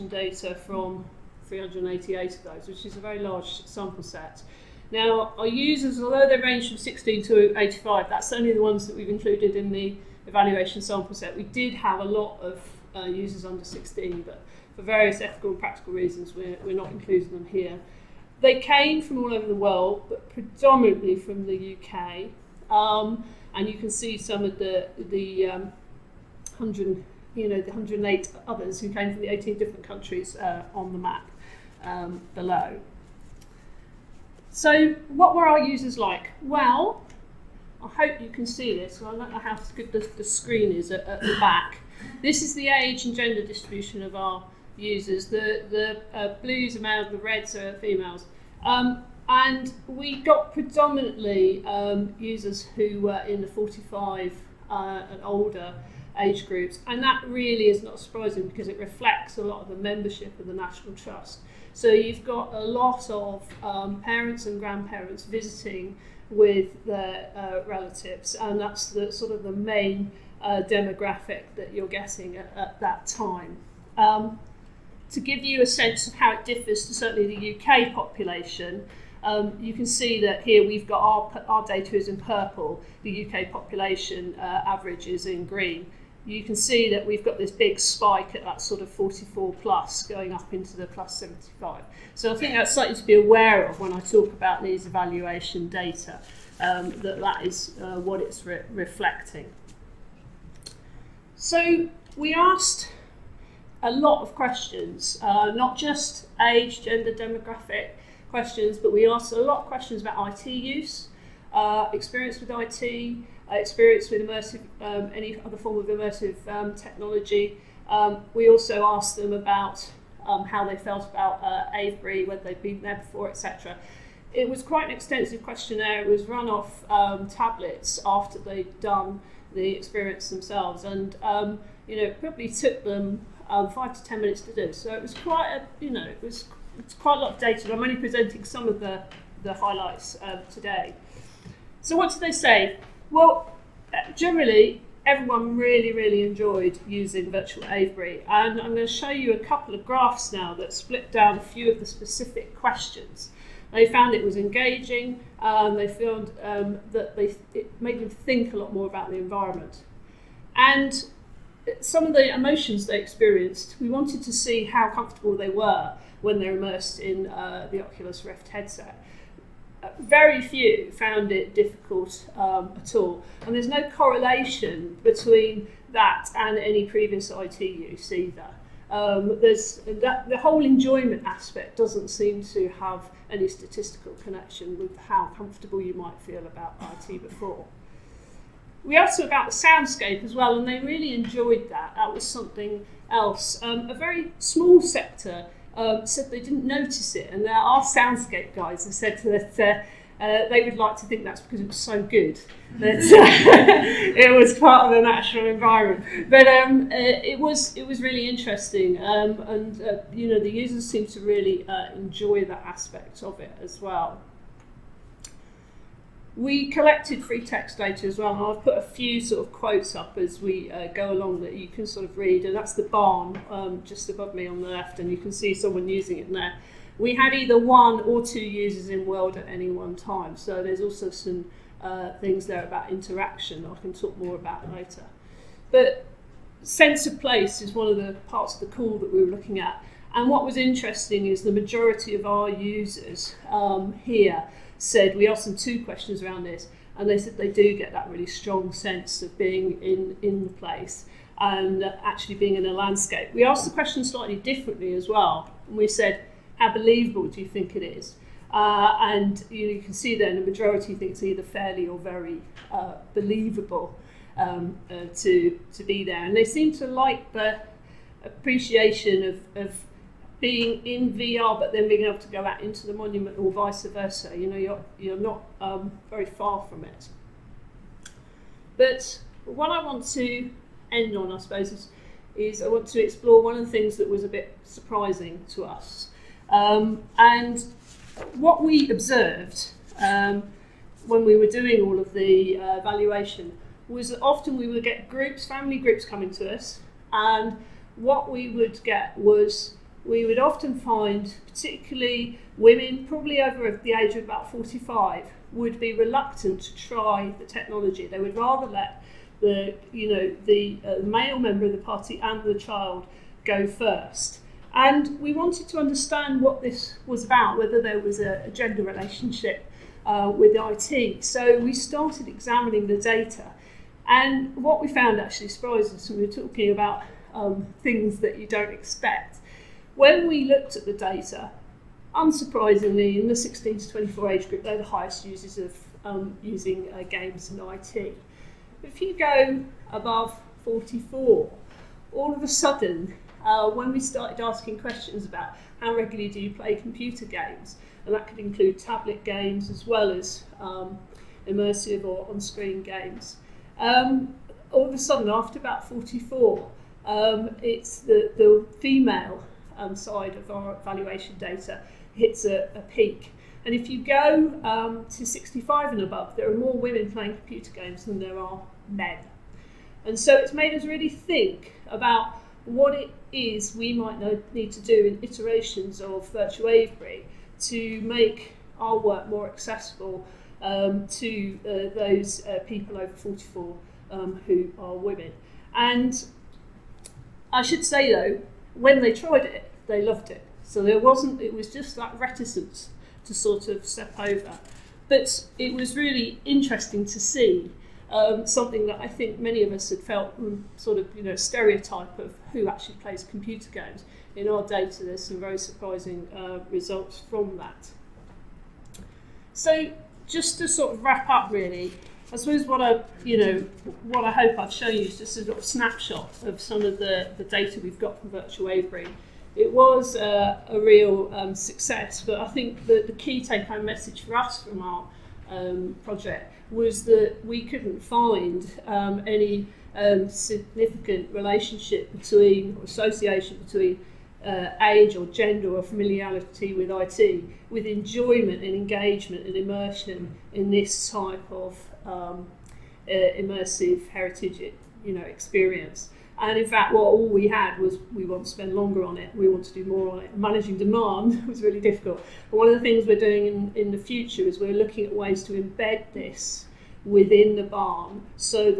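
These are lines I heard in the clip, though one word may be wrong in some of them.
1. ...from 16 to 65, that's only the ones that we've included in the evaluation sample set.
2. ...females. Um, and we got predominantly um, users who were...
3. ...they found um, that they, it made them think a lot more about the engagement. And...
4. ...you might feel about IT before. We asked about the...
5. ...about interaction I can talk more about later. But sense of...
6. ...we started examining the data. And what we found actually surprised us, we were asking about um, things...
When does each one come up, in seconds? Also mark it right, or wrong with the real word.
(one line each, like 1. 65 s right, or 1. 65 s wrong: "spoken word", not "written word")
1. 6 s wrong: "85", not "65"
2. 47 s right
3. 155 s wrong: "environment", not "engagement"
4. 185 s right
5. 232 s right
6. 321 s wrong: "talking", not "asking".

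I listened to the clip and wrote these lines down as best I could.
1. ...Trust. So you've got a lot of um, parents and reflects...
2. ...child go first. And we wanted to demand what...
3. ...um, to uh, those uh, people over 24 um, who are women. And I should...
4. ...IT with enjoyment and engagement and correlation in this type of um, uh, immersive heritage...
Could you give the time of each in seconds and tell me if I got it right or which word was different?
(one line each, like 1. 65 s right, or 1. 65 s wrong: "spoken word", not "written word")
1. 60 s wrong: "grandparents", not "reflects"
2. 312 s wrong: "understand", not "demand"
3. 380 s wrong: "44", not "24"
4. 436 s wrong: "immersion", not "correlation".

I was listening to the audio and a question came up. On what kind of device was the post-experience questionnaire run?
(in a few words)
Tablets.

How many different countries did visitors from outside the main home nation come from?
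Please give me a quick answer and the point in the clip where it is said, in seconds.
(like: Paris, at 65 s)
18, at 29 s.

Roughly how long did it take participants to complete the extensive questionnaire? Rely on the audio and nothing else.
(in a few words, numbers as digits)
5 to 10 minutes.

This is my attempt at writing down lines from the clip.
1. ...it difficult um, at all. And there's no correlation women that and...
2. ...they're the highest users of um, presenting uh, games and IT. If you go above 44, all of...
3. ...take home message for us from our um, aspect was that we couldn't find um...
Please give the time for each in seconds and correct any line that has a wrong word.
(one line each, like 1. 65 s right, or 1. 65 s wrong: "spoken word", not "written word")
1. 171 s wrong: "between", not "women"
2. 334 s wrong: "using", not "presenting"
3. 423 s wrong: "project", not "aspect".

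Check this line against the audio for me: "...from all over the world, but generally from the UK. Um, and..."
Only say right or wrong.
wrong.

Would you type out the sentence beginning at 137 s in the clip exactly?
I'm only presenting some of the the highlights uh, today.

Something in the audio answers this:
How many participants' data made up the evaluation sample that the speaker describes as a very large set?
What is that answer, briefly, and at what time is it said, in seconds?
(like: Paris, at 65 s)
388, at 1 s.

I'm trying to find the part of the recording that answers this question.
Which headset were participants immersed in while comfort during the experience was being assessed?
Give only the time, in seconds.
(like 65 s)
167 s.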